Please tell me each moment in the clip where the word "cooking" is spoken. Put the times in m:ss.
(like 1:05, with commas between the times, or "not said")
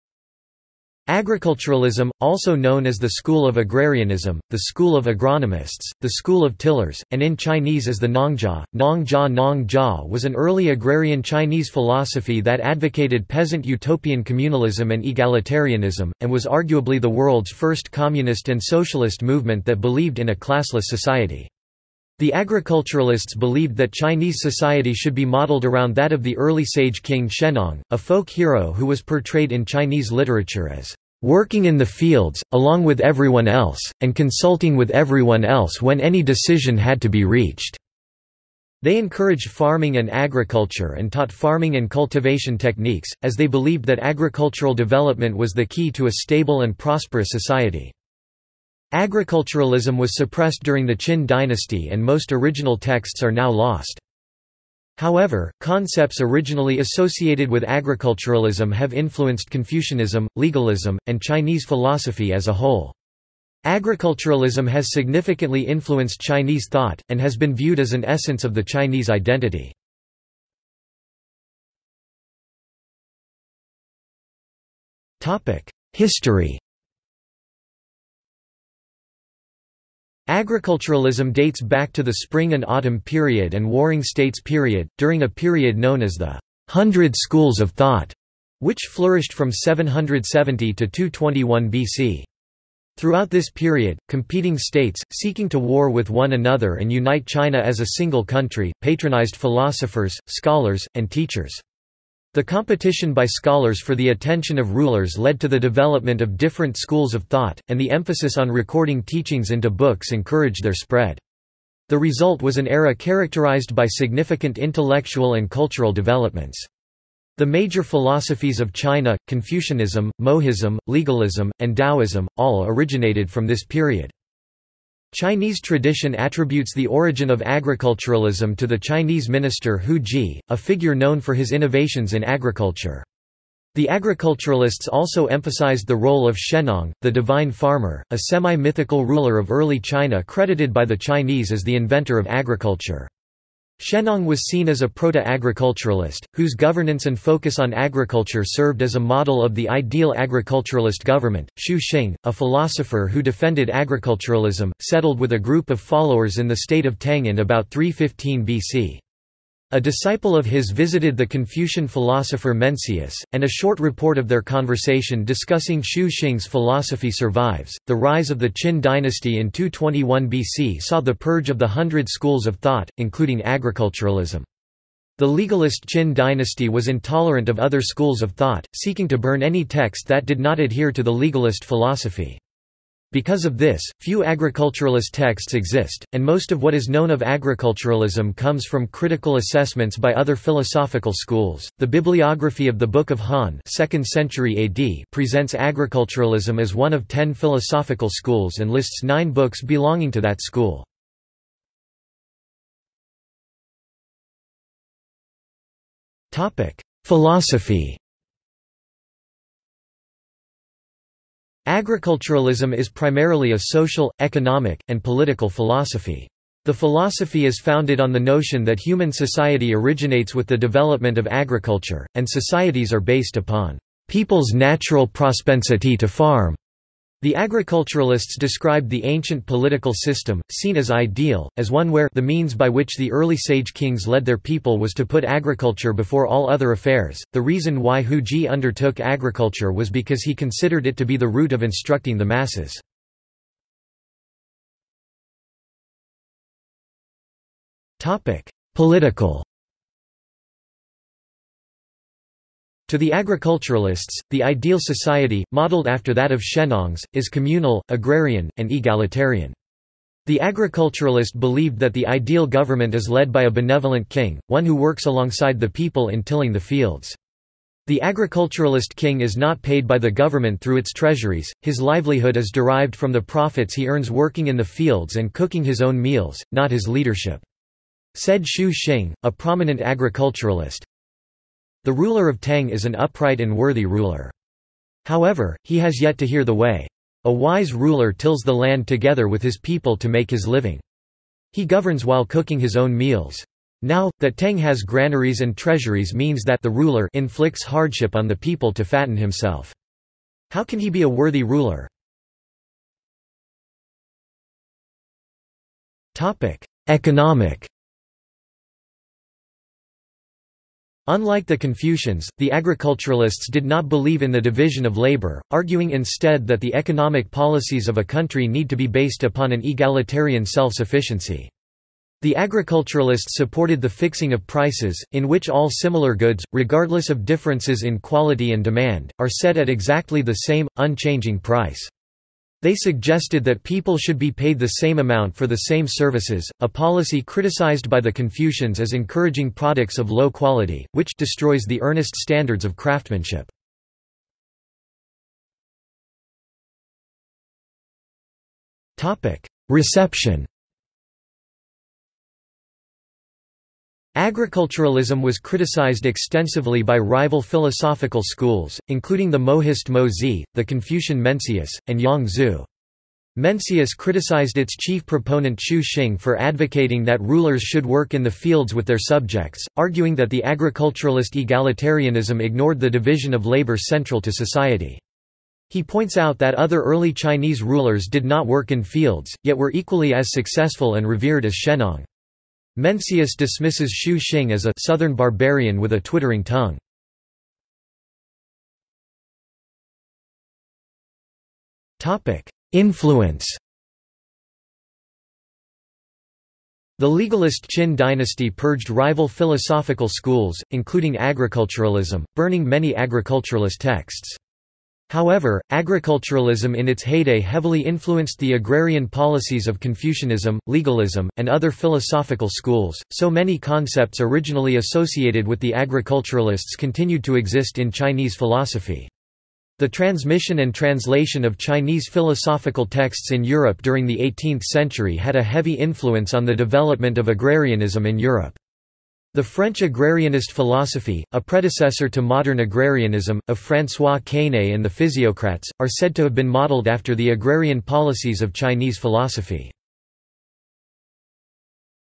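4:35, 4:52.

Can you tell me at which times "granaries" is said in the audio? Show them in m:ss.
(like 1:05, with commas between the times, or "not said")
4:54.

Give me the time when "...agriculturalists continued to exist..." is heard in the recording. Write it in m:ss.
6:55.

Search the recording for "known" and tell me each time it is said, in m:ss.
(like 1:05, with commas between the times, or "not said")
0:02, 1:25, 2:10, 3:06.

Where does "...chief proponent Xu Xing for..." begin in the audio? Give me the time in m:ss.
6:04.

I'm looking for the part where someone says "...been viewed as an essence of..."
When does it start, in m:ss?
1:07.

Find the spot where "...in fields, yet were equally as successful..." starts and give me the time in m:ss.
6:18.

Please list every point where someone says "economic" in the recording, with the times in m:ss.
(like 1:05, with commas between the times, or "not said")
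3:34, 5:06, 5:16.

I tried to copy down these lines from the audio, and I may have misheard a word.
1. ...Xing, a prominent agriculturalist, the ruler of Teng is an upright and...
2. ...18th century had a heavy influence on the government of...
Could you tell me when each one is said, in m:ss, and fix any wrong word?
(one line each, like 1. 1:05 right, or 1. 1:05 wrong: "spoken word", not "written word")
1. 4:38 right
2. 7:04 wrong: "development", not "government".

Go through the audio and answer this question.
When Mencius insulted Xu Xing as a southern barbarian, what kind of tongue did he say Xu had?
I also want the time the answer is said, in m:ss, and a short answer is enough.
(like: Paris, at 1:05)
twittering tongue, at 6:26.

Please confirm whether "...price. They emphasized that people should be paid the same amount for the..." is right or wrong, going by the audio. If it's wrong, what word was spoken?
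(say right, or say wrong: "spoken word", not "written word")
wrong: "suggested", not "emphasized".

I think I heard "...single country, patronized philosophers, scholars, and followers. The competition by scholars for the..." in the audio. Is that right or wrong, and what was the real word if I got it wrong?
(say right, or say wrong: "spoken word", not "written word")
wrong: "teachers", not "followers".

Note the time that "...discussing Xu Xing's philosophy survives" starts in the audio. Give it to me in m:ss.
2:45.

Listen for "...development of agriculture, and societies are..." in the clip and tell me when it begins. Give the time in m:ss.
3:40.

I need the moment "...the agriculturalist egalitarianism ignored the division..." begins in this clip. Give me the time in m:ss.
6:10.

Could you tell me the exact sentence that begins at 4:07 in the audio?
Topic: Political To the agriculturalists, the ideal society, modeled after that of Shennong's, is communal, agrarian, and egalitarian.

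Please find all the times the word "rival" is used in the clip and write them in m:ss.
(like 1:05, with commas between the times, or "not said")
5:56, 6:38.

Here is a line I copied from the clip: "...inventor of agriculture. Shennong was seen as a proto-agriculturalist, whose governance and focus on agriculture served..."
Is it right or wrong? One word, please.
right.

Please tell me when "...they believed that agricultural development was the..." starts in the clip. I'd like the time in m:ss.
0:43.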